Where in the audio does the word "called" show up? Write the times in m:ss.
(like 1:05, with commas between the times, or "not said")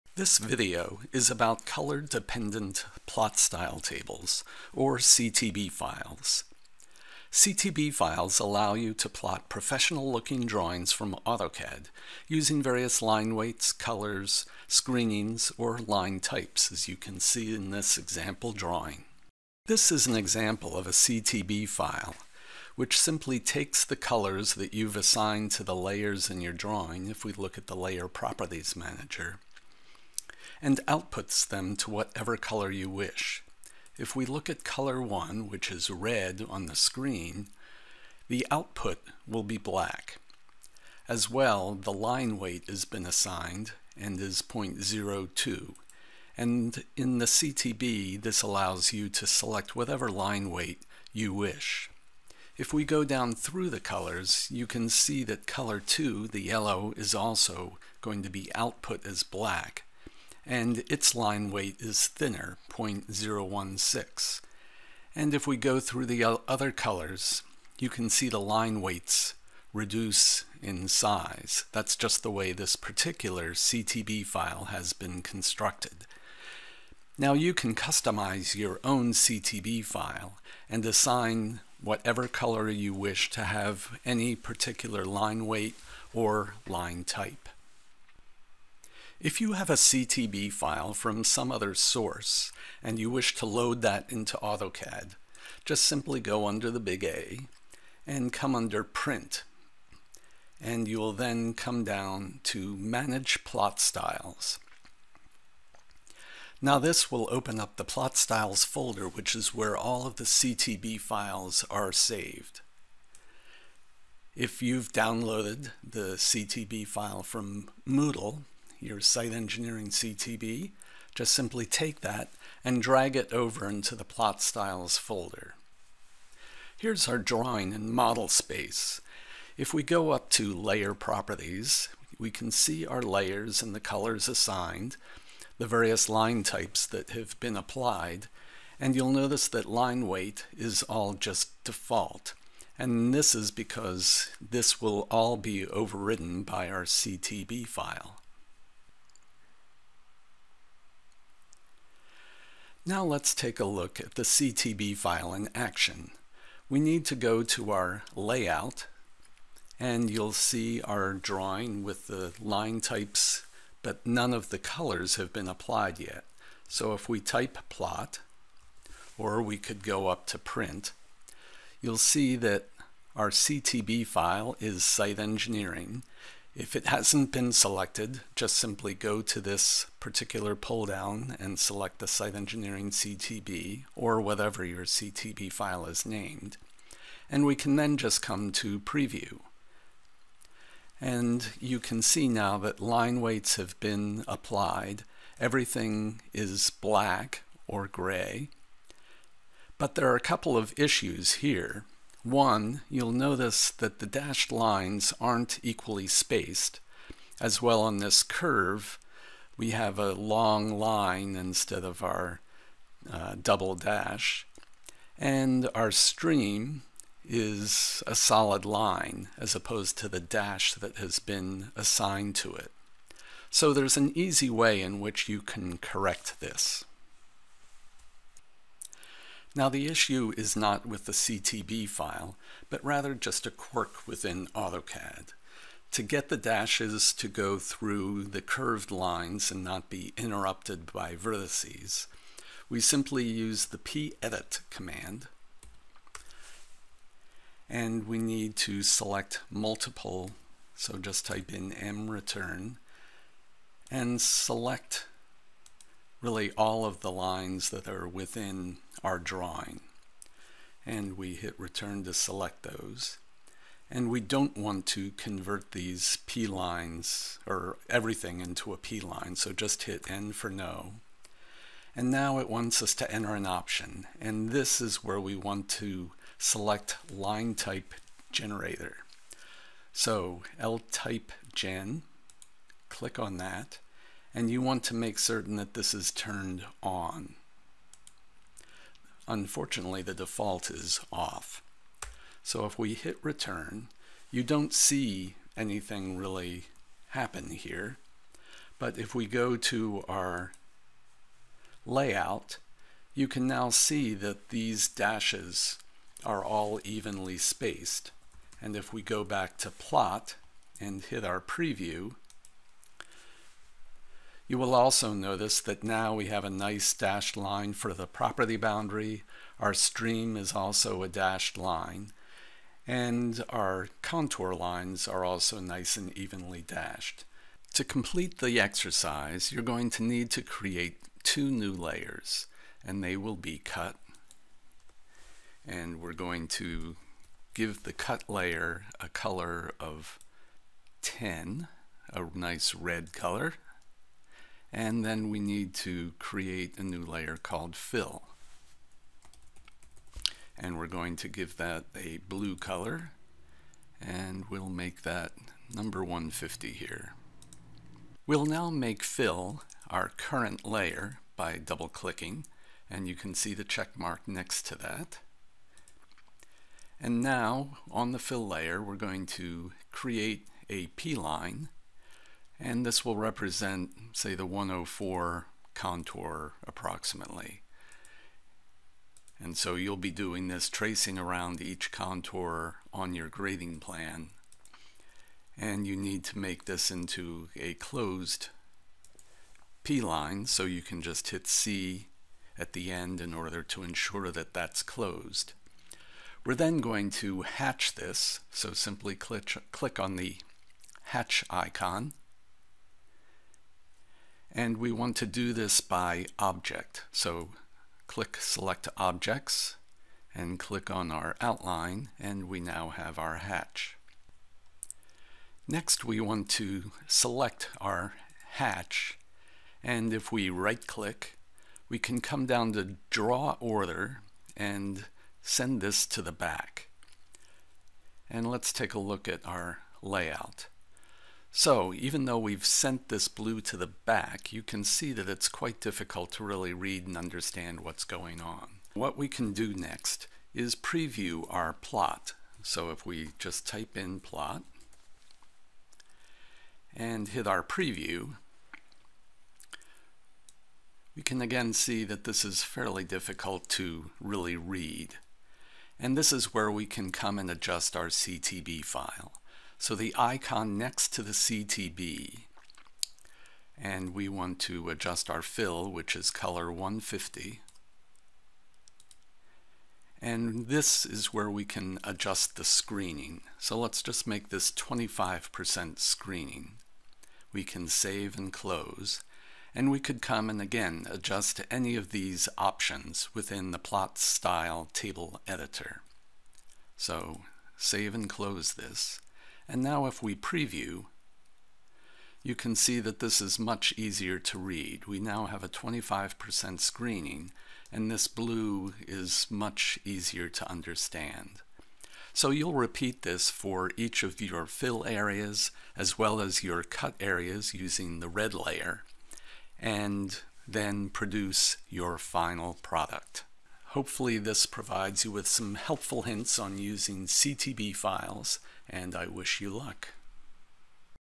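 5:47.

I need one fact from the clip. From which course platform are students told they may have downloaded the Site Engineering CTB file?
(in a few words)
Moodle.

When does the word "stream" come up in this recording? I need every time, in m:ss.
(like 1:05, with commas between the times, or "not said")
3:35, 5:19.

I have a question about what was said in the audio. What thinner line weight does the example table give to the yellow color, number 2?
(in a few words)
0.016.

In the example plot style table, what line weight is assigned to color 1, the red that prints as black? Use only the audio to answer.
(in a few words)
0.02.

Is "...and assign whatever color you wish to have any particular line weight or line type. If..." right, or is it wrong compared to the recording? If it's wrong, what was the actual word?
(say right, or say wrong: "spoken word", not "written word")
right.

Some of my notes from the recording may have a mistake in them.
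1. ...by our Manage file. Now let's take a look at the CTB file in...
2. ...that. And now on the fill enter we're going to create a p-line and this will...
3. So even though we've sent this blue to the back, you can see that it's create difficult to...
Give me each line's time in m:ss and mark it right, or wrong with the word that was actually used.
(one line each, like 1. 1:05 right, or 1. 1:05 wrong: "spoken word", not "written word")
1. 2:26 wrong: "CTB", not "Manage"
2. 6:04 wrong: "layer", not "enter"
3. 7:11 wrong: "quite", not "create".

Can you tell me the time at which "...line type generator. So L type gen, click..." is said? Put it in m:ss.
4:37.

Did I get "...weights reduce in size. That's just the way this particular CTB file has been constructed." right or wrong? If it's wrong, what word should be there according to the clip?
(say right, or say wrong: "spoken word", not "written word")
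right.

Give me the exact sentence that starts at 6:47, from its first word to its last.
So click Select Objects and click on our outline and we now have our hatch.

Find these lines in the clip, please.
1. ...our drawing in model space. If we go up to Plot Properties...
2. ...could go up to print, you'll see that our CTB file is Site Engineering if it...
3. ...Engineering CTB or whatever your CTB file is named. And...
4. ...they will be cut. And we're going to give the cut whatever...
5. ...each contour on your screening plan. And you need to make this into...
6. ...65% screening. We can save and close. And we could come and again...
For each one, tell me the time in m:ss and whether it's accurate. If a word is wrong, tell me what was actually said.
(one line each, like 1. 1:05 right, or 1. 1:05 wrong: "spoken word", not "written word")
1. 2:07 wrong: "Layer", not "Plot"
2. 2:49 right
3. 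3:02 right
4. 5:33 wrong: "layer", not "whatever"
5. 6:21 wrong: "grading", not "screening"
6. 7:54 wrong: "25", not "65".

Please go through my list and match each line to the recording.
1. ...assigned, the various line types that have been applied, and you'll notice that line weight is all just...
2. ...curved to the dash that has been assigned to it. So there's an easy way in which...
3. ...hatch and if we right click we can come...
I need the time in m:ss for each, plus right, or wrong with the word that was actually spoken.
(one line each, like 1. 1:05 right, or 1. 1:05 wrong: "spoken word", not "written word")
1. 2:14 right
2. 3:39 wrong: "opposed", not "curved"
3. 6:58 right.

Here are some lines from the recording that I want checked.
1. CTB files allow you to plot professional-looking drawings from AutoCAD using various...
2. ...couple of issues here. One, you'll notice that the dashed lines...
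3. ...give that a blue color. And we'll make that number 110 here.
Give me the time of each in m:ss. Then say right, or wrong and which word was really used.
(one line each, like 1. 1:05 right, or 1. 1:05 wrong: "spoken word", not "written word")
1. 0:07 right
2. 3:20 right
3. 5:51 wrong: "150", not "110".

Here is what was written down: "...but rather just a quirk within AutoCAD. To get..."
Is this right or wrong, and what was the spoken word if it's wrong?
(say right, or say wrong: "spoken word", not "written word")
right.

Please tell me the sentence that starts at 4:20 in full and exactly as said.
And we hit return to select those.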